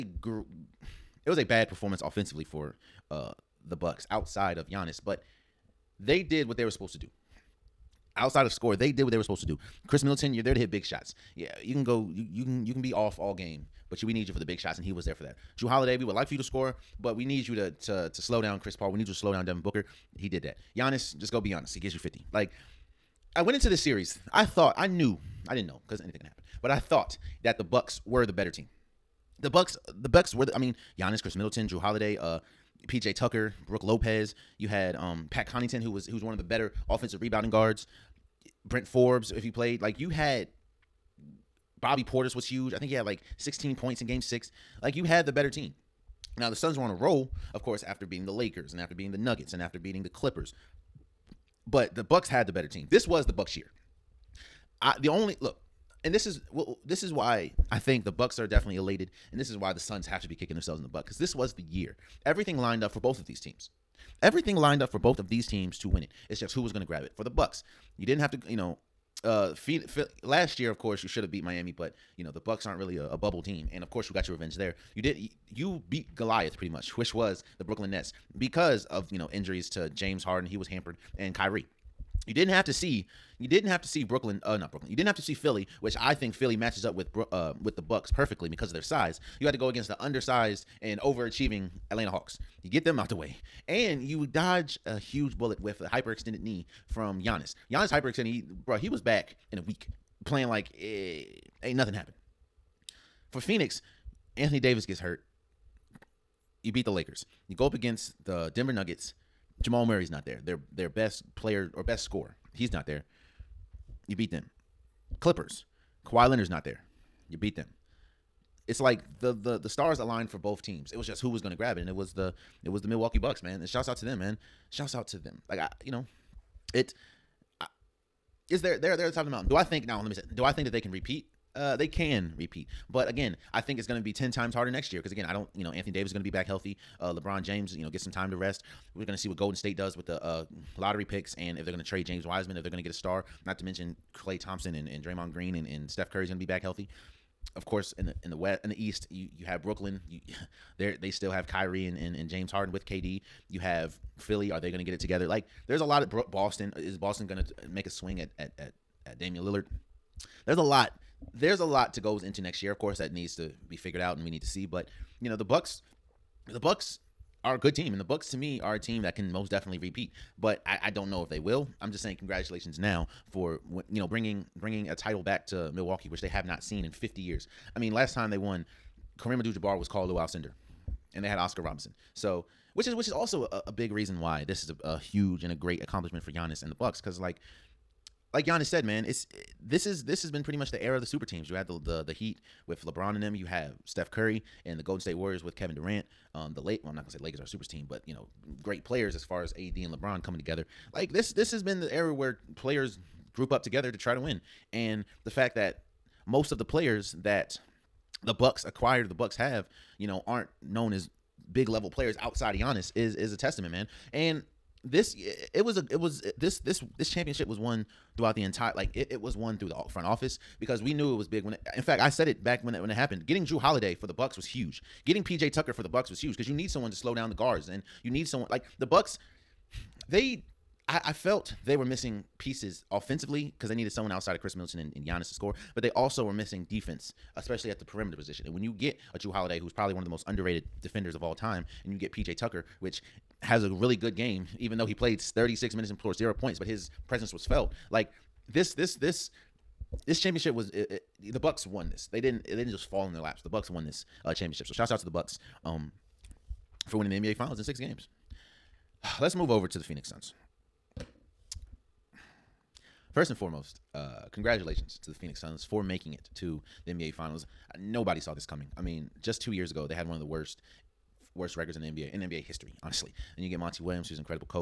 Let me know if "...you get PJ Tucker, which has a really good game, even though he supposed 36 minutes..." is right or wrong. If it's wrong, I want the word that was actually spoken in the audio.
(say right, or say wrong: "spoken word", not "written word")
wrong: "played", not "supposed".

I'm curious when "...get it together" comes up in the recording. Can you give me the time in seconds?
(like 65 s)
154 s.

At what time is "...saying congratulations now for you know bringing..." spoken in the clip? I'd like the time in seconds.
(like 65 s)
172 s.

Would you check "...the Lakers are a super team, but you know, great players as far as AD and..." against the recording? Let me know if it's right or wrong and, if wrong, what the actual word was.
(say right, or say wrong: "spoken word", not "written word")
right.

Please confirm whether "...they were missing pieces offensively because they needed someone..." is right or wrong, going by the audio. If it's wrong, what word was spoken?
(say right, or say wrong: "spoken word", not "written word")
right.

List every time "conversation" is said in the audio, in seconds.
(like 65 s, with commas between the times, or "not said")
not said.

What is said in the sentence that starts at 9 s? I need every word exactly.
Khris Middleton, you're there to hit big shots.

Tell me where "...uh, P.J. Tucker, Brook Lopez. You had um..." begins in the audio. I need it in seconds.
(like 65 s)
32 s.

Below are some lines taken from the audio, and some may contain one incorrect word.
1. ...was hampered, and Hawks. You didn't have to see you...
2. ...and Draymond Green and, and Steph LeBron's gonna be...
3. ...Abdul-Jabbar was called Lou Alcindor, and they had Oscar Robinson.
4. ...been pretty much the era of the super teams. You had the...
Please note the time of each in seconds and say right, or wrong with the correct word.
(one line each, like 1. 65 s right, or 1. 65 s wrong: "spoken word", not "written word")
1. 80 s wrong: "Kyrie", not "Hawks"
2. 144 s wrong: "Curry", not "LeBron"
3. 179 s right
4. 190 s right.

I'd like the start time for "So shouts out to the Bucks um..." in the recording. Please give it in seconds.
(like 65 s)
254 s.